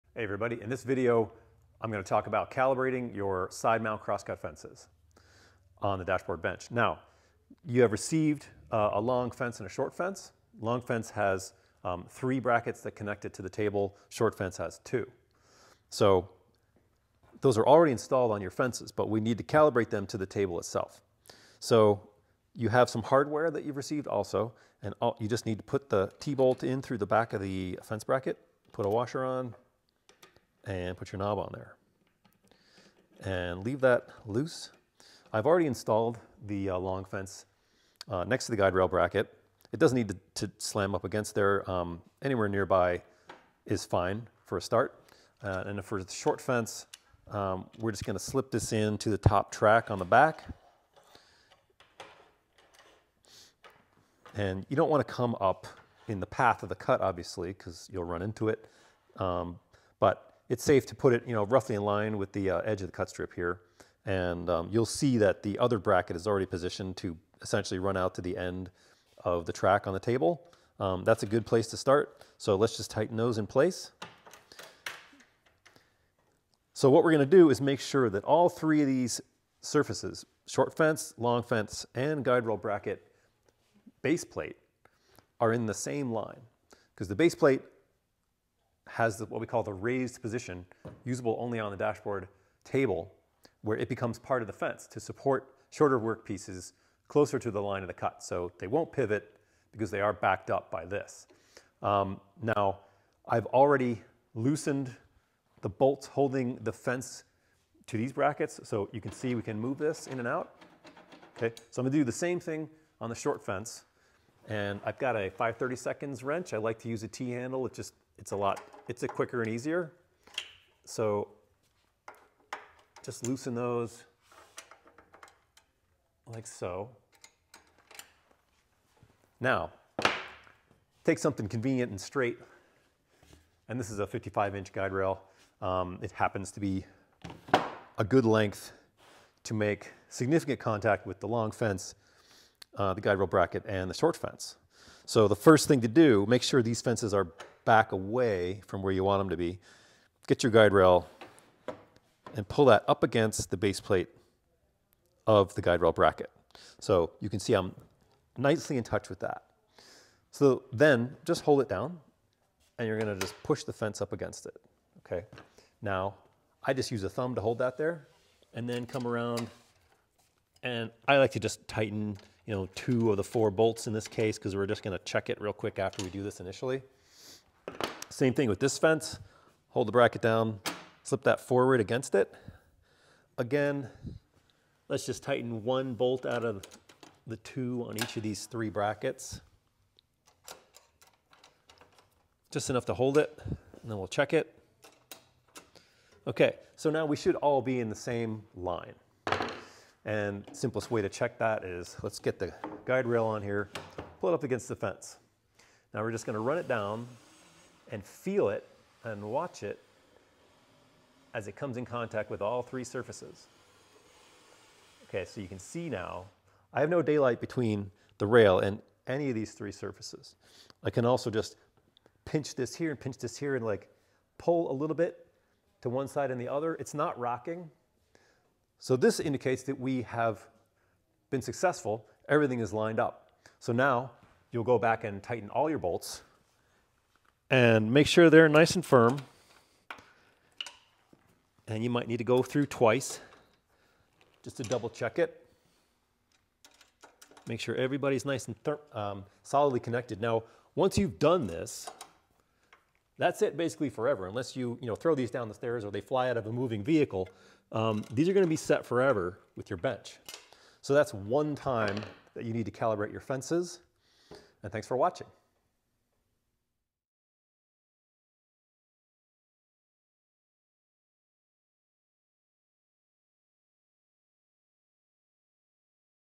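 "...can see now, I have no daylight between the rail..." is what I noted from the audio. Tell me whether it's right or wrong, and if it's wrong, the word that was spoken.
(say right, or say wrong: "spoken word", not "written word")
right.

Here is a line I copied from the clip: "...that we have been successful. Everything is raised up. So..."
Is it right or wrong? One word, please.
wrong.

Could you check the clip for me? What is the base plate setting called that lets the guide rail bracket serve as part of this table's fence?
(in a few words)
raised position.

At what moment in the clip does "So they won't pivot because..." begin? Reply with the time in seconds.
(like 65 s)
98 s.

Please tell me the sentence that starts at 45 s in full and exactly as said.
Uh, and for the short fence, um, we're just gonna slip this into the top track on the back.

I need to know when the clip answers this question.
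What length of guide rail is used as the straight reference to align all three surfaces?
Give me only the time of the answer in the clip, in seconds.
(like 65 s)
134 s.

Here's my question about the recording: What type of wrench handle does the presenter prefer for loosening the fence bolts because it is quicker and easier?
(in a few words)
T-handle.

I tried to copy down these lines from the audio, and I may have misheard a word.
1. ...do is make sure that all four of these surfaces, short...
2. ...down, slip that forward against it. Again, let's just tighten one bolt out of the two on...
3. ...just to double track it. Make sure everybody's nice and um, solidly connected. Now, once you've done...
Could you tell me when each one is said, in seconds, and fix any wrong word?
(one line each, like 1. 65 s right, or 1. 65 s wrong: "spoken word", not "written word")
1. 77 s wrong: "three", not "four"
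2. 180 s right
3. 244 s wrong: "check", not "track".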